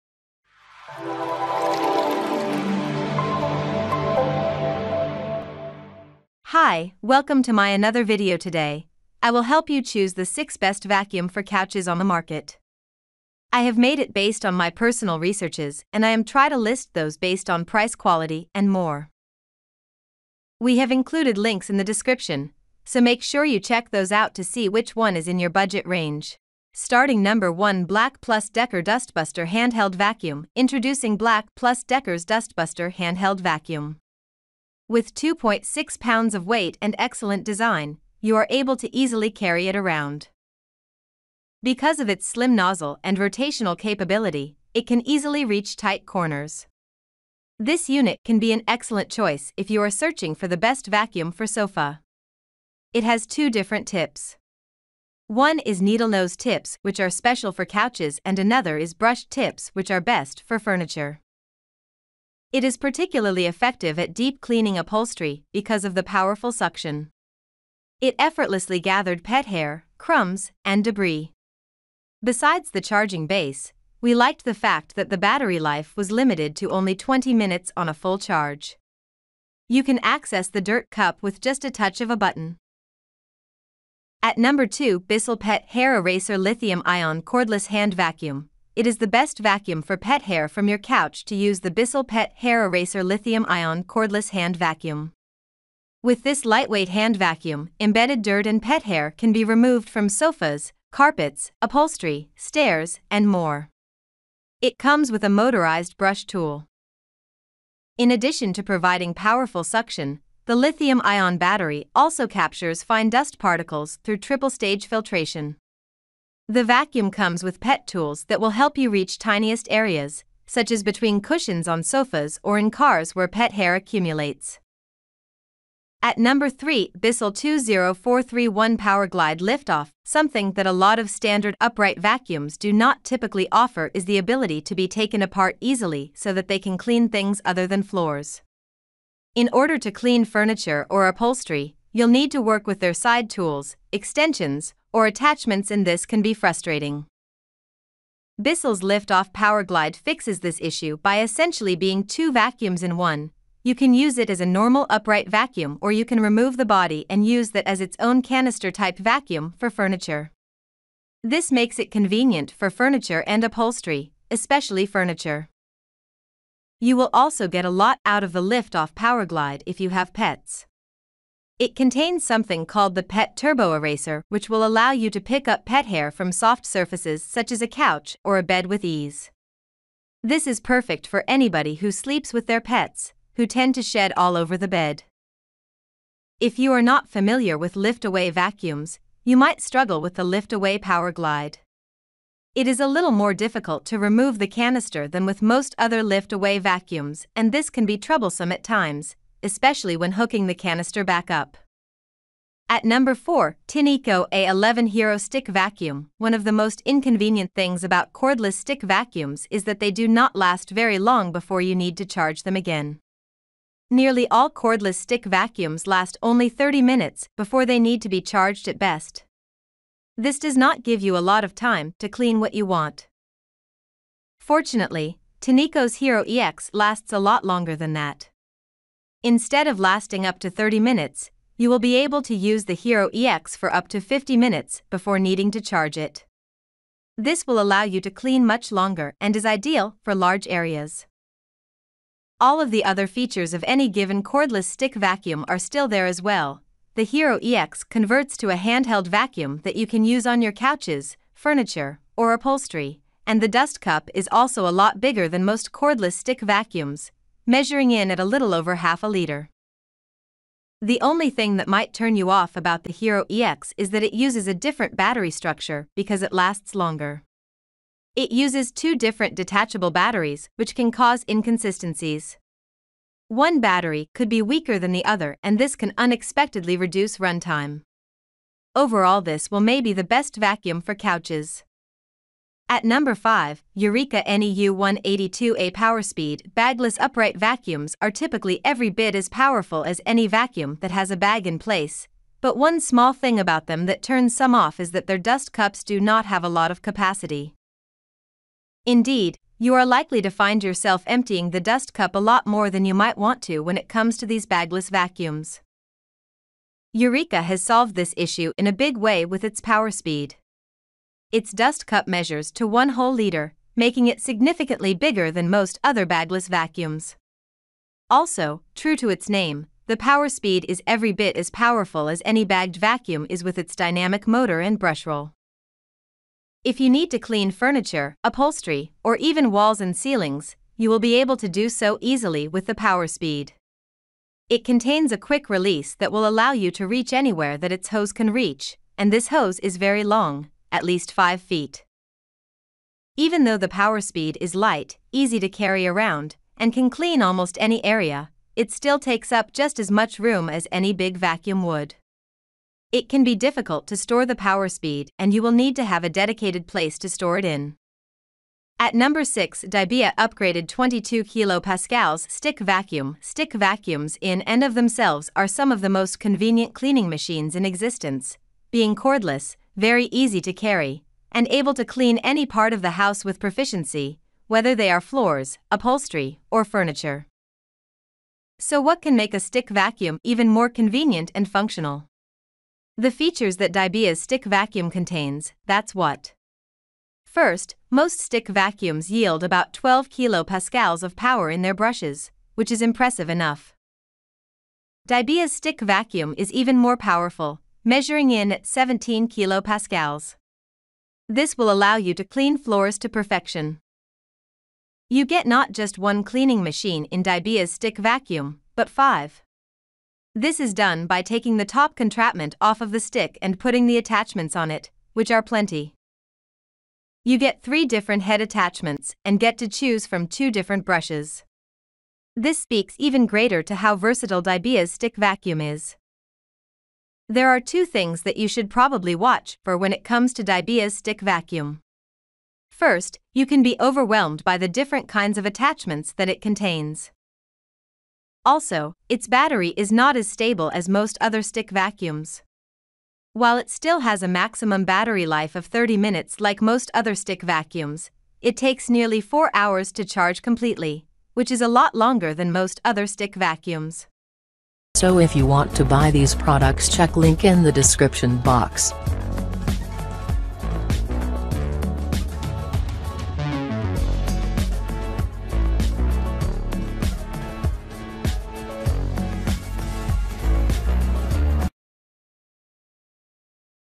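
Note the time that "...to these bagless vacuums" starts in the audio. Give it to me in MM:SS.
05:04.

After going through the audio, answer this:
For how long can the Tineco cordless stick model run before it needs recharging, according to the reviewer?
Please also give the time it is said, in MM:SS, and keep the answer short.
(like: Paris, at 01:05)
50 minutes, at 03:54.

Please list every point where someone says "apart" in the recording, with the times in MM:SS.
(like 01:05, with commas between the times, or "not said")
02:15.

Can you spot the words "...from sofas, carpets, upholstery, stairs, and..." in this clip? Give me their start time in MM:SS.
01:39.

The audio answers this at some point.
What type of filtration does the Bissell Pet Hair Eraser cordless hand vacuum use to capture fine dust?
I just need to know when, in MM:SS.
01:54.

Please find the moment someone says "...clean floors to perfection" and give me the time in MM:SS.
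06:42.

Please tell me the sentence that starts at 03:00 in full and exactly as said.
This is perfect for anybody who sleeps with their pets, who tend to shed all over the bed.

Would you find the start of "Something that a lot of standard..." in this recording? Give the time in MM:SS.
02:10.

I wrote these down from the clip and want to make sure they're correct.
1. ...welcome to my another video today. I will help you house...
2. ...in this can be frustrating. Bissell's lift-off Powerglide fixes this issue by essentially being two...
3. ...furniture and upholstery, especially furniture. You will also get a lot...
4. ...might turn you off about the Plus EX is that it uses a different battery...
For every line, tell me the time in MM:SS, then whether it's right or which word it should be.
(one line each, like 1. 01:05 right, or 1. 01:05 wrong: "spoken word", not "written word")
1. 00:07 wrong: "choose", not "house"
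2. 02:25 right
3. 02:42 right
4. 04:21 wrong: "Hero", not "Plus".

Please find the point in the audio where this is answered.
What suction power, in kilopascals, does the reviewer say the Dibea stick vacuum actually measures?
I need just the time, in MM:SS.
06:38.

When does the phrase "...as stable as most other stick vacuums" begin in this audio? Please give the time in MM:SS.
07:20.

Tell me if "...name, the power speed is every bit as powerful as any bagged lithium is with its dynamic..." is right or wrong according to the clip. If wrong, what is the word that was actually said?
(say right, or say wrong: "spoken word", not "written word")
wrong: "vacuum", not "lithium".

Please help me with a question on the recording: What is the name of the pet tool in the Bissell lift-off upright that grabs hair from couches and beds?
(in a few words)
Pet Turbo Eraser.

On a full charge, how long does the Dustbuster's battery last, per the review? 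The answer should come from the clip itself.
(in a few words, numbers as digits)
20 minutes.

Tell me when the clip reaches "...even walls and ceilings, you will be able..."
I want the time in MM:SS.
05:29.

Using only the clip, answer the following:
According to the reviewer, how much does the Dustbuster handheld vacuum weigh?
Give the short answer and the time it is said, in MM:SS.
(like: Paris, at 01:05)
2.6 pounds, at 00:35.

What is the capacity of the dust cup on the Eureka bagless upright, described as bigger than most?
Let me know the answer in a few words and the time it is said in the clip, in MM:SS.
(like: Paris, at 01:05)
1 liter, at 05:12.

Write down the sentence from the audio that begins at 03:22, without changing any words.
At number 4, Tineco A11 Hero Stick Vacuum.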